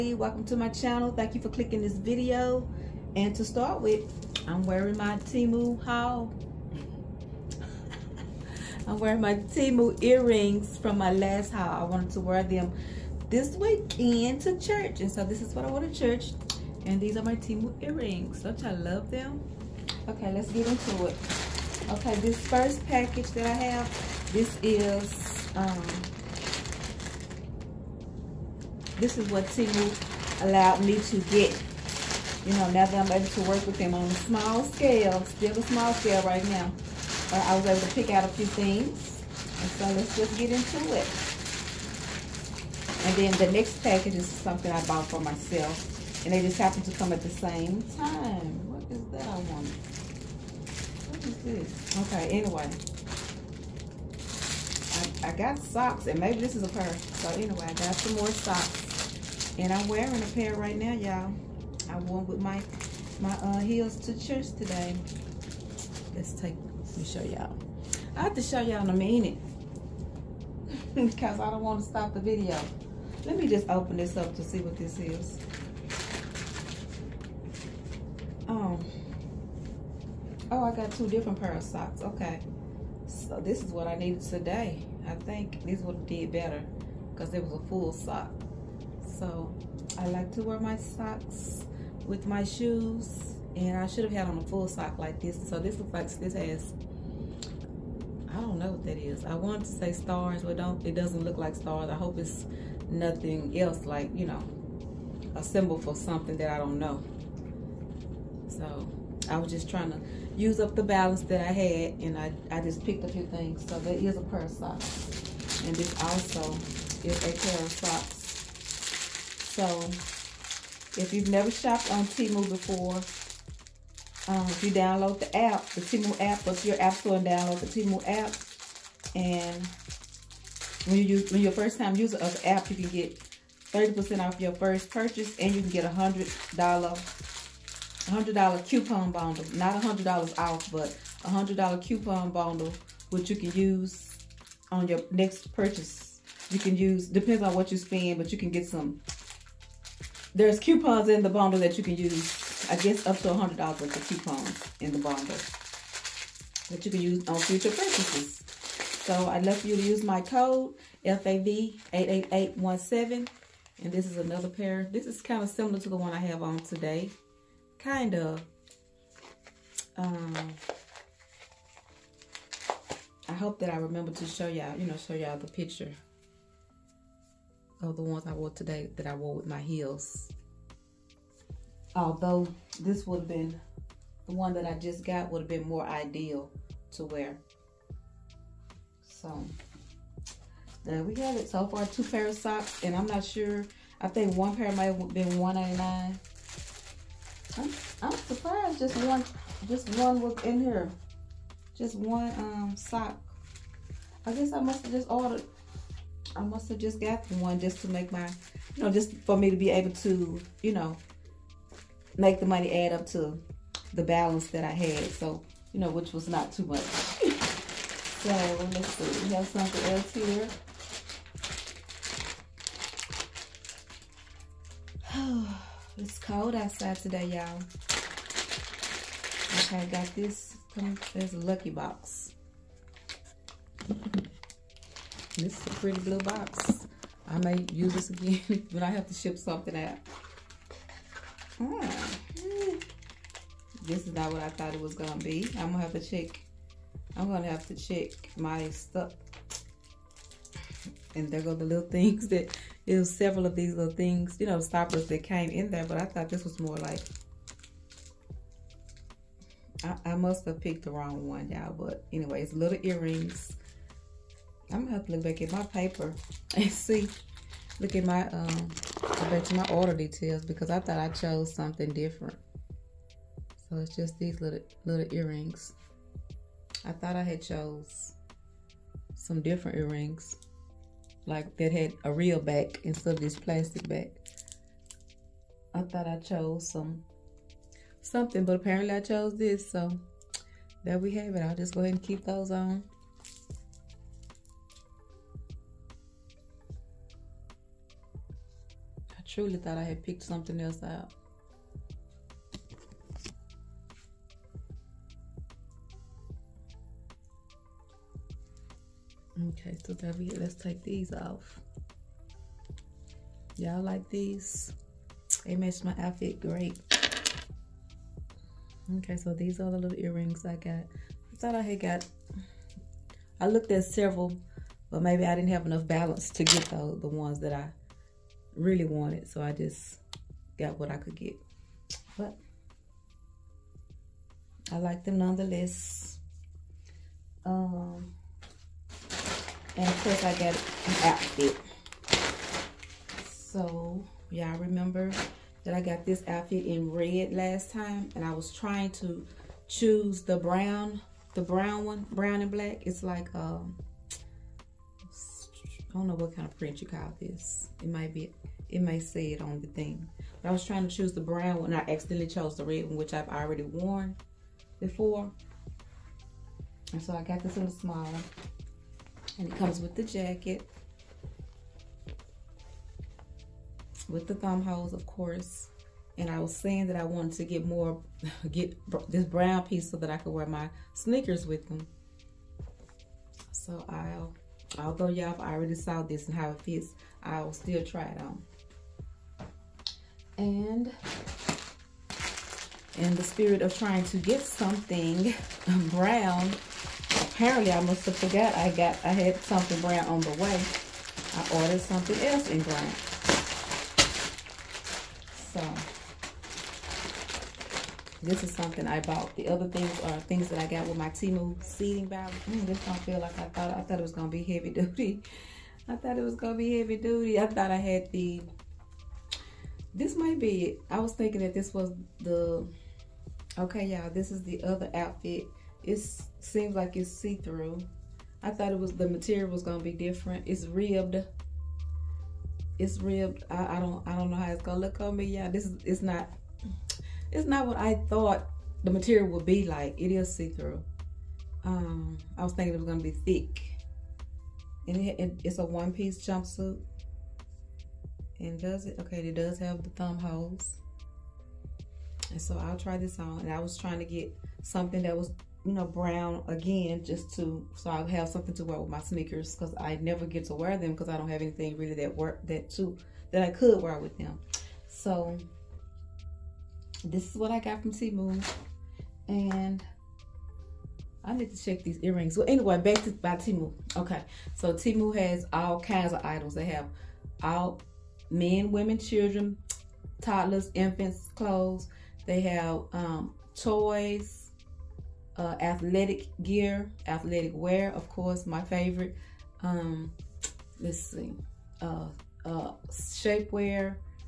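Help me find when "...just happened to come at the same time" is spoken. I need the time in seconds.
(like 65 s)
46 s.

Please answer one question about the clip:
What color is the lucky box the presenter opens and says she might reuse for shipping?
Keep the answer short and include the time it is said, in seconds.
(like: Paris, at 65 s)
blue, at 235 s.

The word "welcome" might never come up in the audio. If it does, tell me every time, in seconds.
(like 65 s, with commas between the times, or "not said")
0 s.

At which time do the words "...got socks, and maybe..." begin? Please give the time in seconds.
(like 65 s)
55 s.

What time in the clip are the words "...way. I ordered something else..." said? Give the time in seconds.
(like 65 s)
400 s.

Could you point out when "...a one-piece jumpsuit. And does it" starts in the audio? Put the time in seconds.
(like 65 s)
445 s.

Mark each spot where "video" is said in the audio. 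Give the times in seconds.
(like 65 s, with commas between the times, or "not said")
1 s, 72 s.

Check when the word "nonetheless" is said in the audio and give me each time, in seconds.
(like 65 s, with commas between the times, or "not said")
335 s.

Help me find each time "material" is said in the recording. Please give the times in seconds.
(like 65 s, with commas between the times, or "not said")
429 s, 438 s.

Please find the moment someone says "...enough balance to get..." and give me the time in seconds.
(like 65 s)
325 s.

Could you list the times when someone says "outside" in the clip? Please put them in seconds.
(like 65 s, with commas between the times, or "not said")
226 s.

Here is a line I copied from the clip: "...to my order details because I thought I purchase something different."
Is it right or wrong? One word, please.
wrong.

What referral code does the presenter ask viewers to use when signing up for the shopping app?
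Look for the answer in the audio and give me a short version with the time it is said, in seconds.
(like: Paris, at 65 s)
FAV88817, at 161 s.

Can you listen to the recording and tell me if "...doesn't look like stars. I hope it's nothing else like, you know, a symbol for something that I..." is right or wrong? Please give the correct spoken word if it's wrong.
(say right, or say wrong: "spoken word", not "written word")
right.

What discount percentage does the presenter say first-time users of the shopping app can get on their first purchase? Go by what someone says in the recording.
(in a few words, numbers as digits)
30%.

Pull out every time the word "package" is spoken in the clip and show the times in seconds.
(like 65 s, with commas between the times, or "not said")
22 s, 43 s.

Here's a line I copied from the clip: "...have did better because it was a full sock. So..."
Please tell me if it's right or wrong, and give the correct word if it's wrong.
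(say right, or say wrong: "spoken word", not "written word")
right.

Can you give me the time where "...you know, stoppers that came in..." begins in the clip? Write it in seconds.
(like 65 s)
254 s.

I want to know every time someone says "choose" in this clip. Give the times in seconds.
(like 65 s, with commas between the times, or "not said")
349 s, 360 s.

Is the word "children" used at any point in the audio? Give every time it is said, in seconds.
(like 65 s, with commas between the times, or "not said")
478 s.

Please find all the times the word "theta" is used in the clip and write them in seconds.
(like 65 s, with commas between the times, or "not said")
not said.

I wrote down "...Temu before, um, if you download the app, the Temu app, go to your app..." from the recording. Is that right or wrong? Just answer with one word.
right.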